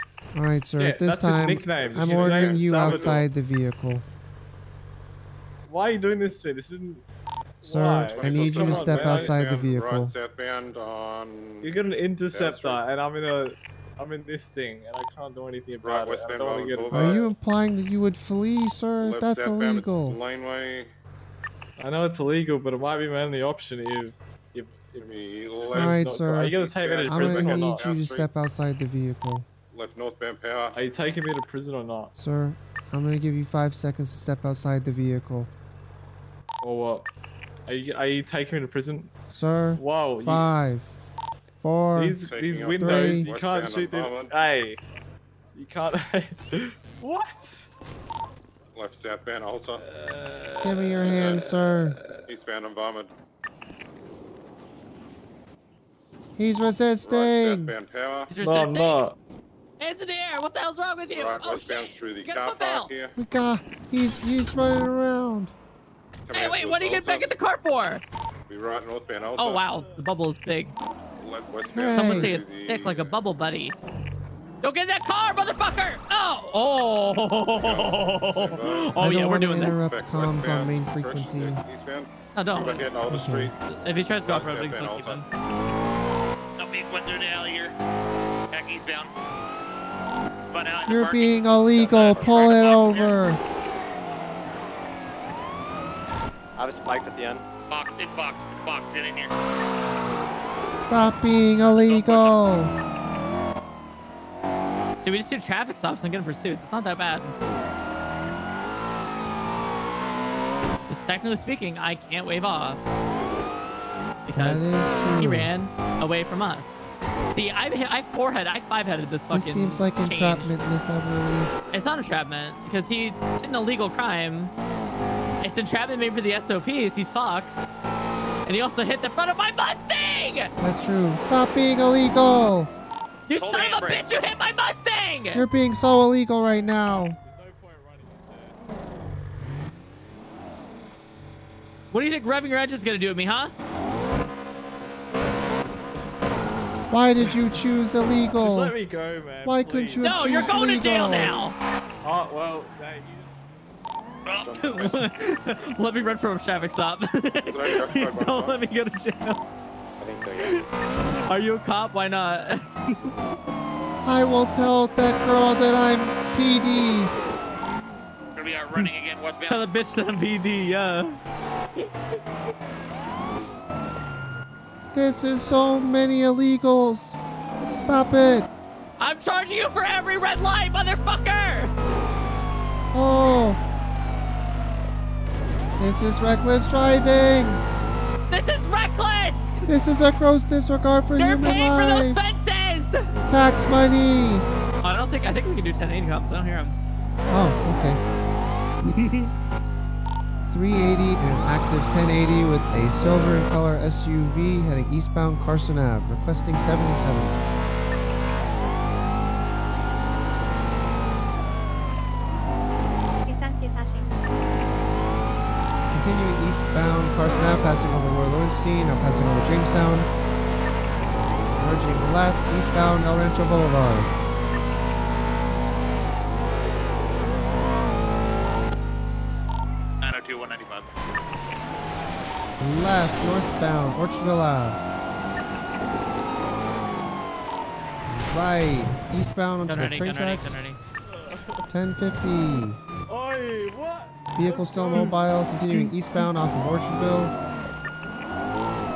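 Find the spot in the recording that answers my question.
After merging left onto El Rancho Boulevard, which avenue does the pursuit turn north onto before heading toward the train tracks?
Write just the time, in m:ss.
3:53.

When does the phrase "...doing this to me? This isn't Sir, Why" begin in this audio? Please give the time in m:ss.
0:05.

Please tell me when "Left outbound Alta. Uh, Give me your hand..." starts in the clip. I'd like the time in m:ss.
0:48.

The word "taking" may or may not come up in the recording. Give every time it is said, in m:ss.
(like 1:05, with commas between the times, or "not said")
0:30, 0:38.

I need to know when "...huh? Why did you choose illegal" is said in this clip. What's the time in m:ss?
2:23.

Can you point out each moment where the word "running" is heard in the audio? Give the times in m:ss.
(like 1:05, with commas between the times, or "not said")
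1:04, 2:48.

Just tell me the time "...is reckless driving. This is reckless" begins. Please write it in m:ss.
3:05.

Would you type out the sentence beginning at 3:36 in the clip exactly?
Bound Carson Ave, passing over Roy Lowenstein, now passing over Jamestown.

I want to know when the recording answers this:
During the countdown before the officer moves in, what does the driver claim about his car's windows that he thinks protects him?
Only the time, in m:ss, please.
0:43.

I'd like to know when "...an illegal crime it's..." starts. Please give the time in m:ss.
2:03.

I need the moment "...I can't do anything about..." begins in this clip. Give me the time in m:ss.
0:14.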